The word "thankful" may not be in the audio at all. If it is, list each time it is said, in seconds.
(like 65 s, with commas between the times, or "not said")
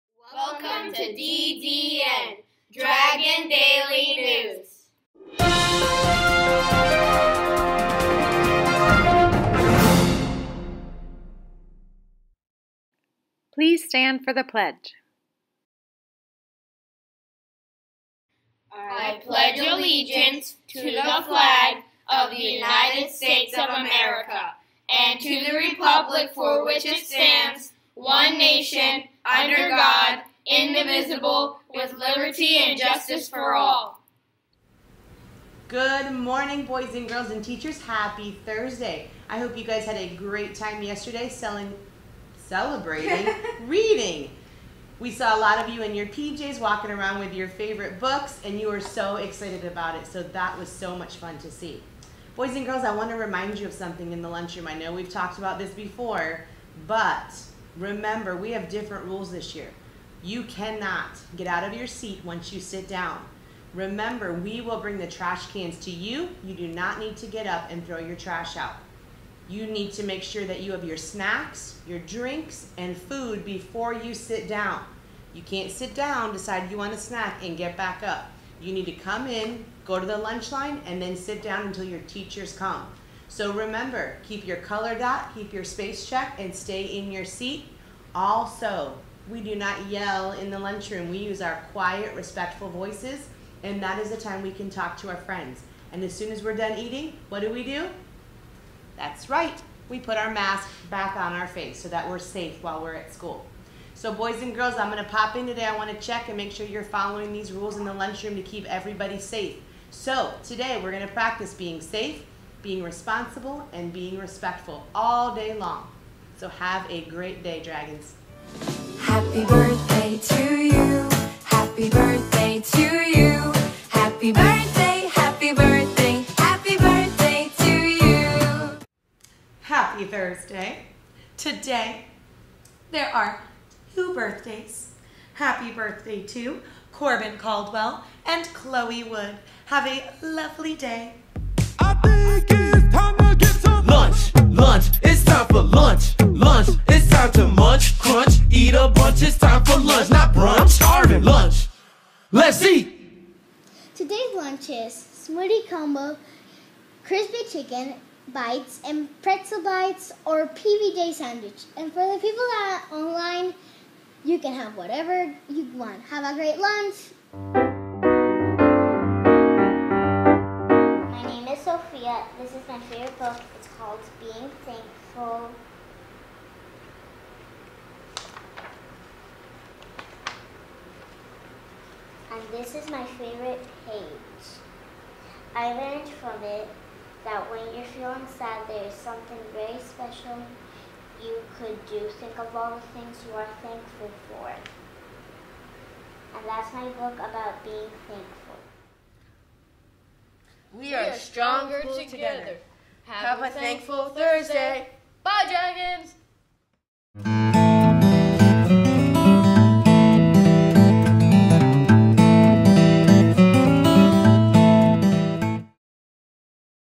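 174 s, 193 s, 198 s, 203 s.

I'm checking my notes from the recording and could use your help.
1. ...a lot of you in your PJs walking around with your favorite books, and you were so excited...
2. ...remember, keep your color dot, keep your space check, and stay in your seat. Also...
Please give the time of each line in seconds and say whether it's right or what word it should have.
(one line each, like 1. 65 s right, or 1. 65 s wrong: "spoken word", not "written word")
1. 45 s right
2. 83 s right.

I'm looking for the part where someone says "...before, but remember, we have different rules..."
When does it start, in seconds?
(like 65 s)
55 s.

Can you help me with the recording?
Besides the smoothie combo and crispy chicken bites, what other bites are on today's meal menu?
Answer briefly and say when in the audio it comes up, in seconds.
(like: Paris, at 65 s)
pretzel bites, at 159 s.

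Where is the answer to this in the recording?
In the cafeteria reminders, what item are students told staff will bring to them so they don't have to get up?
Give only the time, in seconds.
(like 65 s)
65 s.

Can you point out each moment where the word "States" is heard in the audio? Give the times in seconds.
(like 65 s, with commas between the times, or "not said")
23 s.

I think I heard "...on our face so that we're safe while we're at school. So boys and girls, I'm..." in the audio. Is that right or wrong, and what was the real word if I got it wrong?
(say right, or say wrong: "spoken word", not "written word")
right.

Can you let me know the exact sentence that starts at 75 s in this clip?
You can't sit down, decide you want a snack, and get back up.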